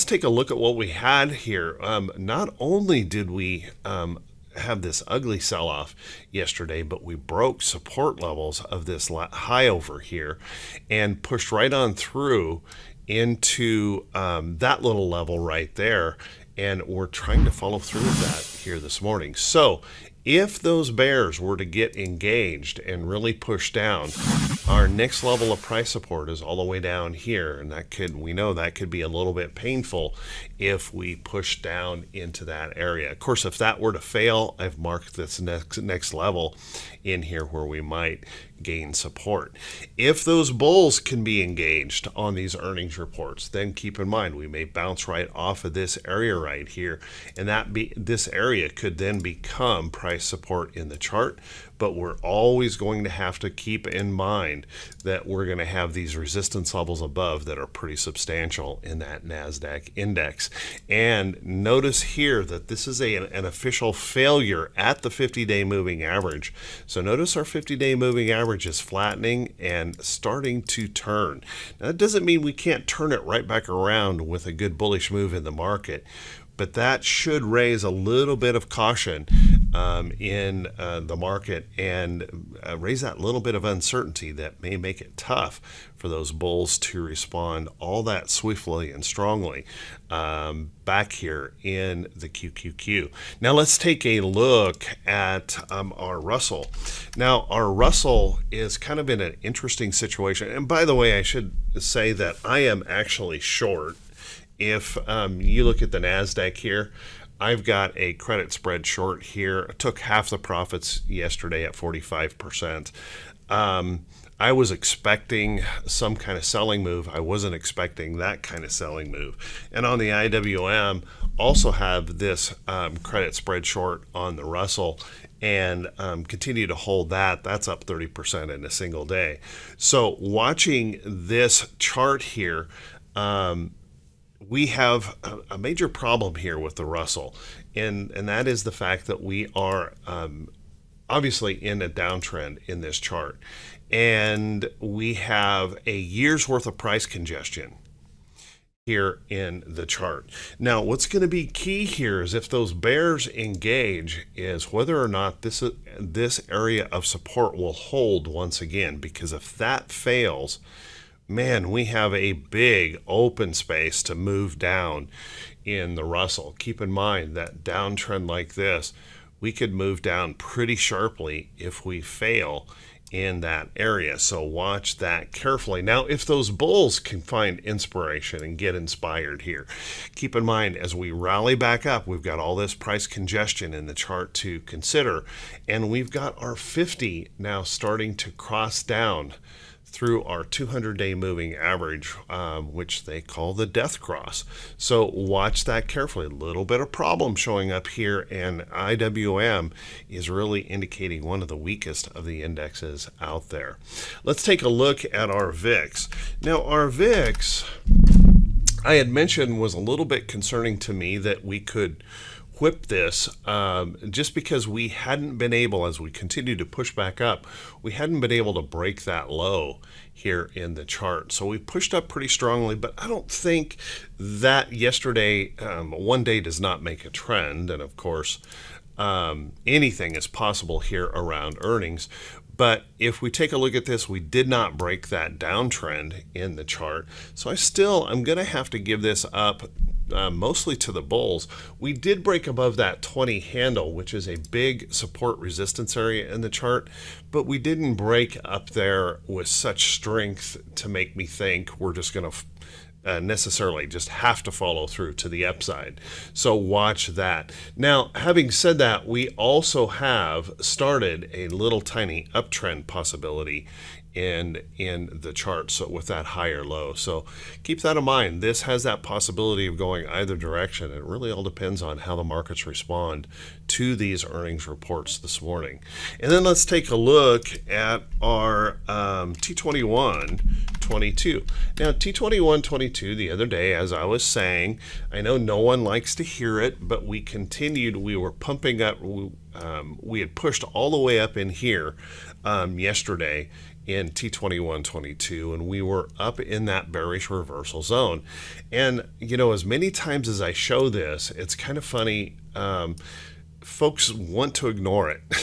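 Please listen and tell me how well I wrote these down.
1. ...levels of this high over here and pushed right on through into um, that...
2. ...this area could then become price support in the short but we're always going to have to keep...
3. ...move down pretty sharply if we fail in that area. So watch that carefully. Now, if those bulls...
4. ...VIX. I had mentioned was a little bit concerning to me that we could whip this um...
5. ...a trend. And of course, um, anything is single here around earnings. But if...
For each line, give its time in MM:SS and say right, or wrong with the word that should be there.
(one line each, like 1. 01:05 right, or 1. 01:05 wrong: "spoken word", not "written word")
1. 00:08 right
2. 00:47 wrong: "chart", not "short"
3. 02:49 right
4. 03:26 right
5. 03:47 wrong: "possible", not "single".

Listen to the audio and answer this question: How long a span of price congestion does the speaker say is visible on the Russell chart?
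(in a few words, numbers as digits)
a year.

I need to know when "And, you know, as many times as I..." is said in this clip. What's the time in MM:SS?
04:58.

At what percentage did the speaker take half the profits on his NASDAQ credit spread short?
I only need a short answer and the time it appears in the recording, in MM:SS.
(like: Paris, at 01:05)
45%, at 01:51.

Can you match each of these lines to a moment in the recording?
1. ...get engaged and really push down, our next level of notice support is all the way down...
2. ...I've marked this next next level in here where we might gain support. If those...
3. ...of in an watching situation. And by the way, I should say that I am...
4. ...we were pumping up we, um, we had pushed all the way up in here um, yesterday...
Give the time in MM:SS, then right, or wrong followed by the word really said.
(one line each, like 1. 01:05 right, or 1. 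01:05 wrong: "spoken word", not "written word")
1. 00:21 wrong: "price", not "notice"
2. 00:34 right
3. 01:39 wrong: "interesting", not "watching"
4. 04:47 right.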